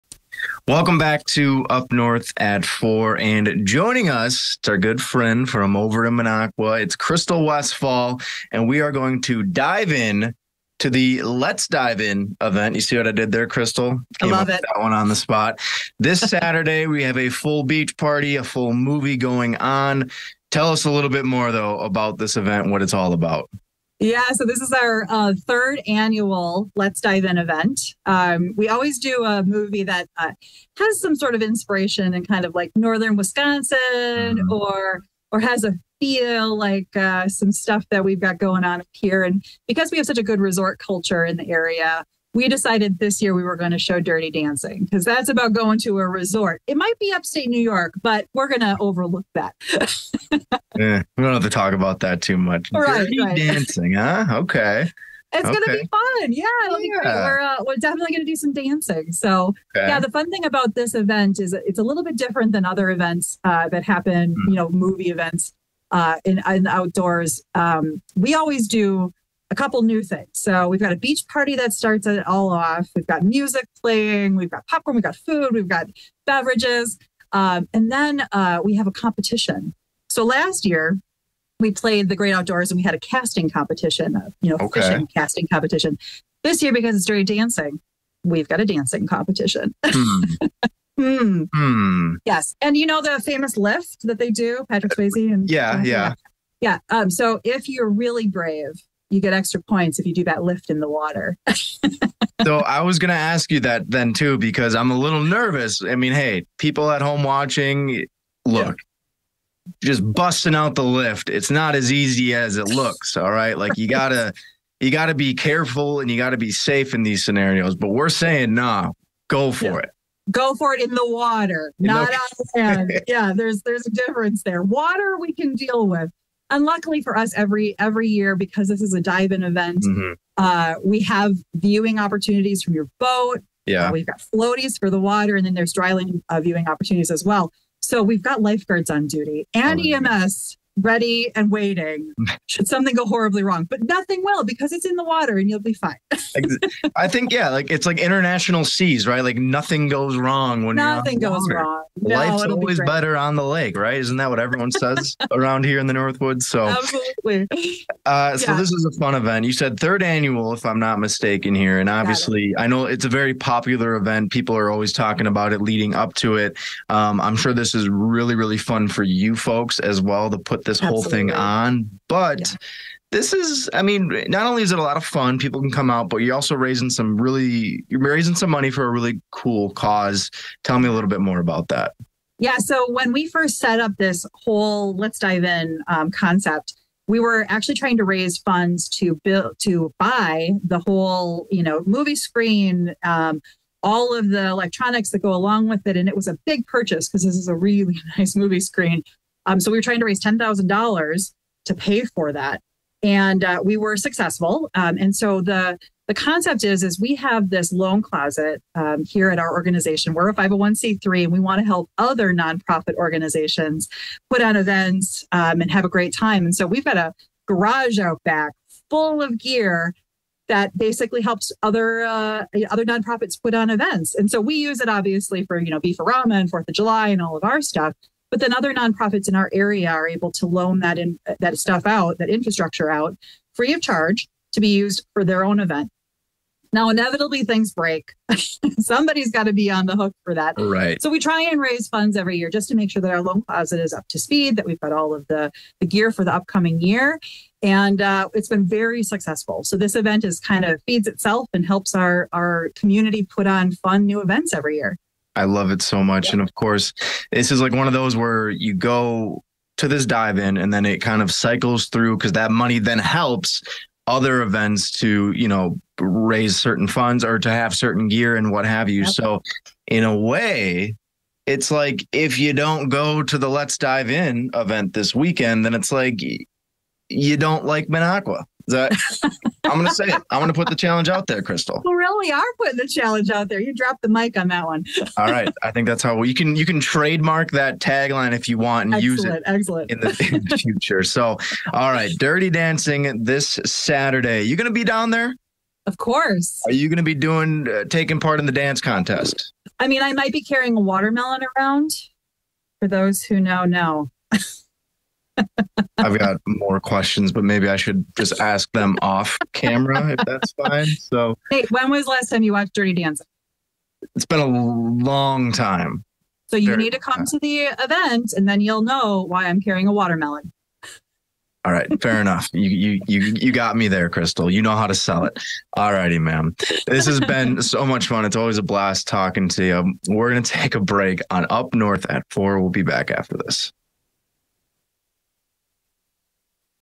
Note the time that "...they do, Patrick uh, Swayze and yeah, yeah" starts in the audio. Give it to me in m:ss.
1:34.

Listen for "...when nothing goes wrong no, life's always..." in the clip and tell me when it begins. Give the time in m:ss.
2:30.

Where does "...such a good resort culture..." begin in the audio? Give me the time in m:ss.
0:40.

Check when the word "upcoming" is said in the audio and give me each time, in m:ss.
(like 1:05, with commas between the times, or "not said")
4:06.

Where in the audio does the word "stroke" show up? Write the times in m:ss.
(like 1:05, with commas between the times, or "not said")
not said.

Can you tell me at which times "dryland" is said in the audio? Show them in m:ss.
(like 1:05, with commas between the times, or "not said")
2:15.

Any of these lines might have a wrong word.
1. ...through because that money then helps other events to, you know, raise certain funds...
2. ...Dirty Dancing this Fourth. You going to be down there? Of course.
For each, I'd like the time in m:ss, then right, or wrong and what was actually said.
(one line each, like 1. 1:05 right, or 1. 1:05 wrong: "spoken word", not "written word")
1. 4:21 right
2. 4:52 wrong: "Saturday", not "Fourth".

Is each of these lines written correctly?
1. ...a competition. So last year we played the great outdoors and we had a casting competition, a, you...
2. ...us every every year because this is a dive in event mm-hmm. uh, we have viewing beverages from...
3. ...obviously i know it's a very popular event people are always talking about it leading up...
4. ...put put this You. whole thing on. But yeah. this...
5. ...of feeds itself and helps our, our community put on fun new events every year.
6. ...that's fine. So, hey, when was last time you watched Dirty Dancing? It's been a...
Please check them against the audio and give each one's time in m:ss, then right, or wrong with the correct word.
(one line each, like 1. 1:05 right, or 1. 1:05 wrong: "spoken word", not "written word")
1. 1:18 right
2. 2:07 wrong: "opportunities", not "beverages"
3. 2:41 right
4. 2:50 wrong: "Absolutely", not "You"
5. 4:10 right
6. 5:10 right.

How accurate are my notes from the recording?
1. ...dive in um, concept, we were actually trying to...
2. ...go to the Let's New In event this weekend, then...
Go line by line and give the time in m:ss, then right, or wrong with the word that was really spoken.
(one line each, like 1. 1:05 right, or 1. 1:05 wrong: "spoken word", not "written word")
1. 3:05 right
2. 4:32 wrong: "Dive", not "New".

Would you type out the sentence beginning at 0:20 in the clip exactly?
Tell us a little bit more, though, about this event, what it's all about.